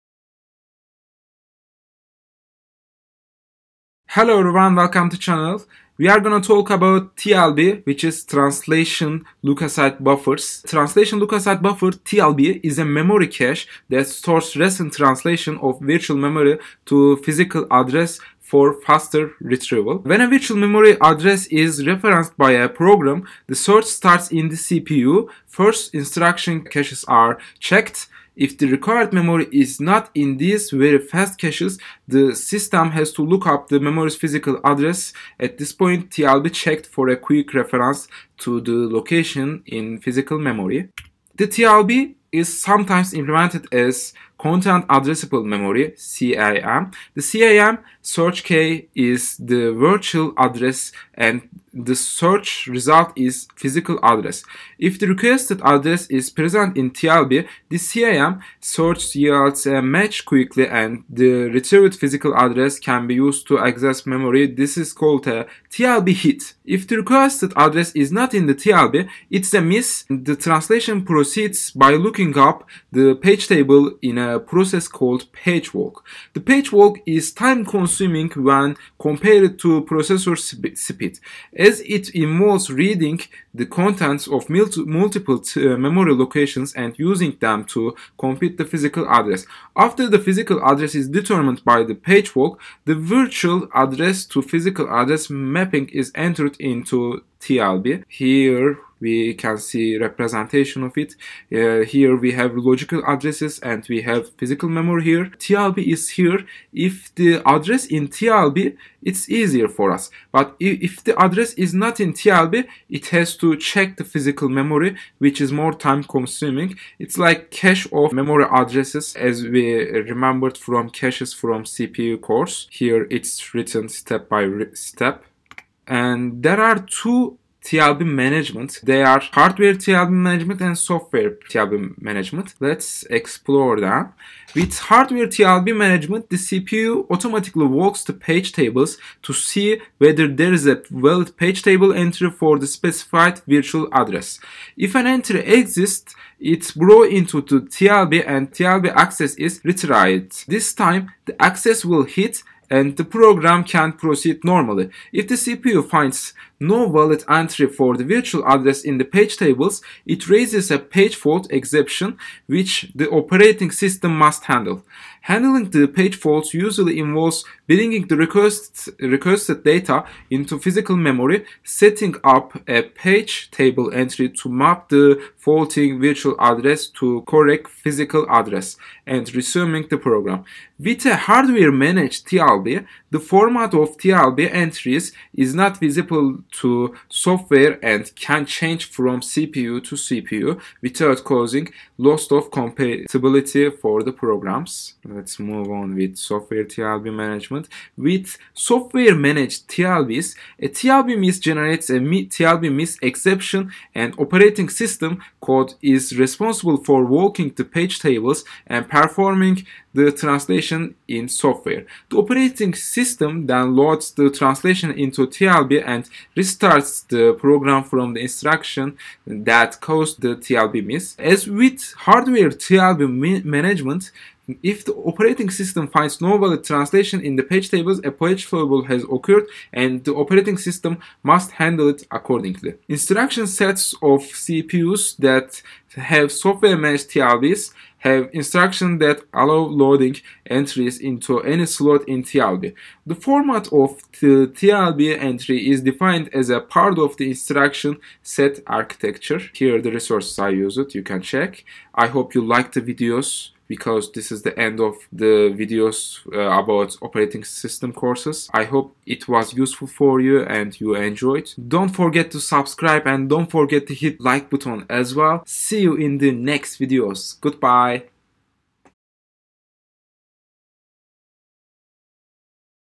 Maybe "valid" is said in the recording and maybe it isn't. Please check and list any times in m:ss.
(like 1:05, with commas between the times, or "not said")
2:20, 2:36, 3:46.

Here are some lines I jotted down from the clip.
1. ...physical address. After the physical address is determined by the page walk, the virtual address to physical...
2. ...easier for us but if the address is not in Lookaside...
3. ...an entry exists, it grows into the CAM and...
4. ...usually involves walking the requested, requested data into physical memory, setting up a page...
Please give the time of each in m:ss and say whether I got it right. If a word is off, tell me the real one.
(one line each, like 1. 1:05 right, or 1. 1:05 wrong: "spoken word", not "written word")
1. 1:28 right
2. 1:49 wrong: "TLB", not "Lookaside"
3. 2:24 wrong: "TLB", not "CAM"
4. 2:46 wrong: "bringing", not "walking".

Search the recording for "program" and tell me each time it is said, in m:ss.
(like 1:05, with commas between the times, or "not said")
0:22, 2:33, 2:59, 3:14, 3:37.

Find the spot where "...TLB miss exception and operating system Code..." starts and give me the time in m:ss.
3:21.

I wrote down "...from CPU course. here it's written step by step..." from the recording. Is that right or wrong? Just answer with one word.
right.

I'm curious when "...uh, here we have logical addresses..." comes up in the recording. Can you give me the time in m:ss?
1:41.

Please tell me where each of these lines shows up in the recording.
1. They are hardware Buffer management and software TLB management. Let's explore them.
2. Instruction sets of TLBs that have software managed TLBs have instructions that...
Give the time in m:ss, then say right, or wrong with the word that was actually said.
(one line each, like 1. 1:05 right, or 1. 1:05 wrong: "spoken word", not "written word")
1. 2:08 wrong: "TLB", not "Buffer"
2. 3:52 wrong: "CPUs", not "TLBs".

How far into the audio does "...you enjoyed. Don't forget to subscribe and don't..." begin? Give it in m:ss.
4:20.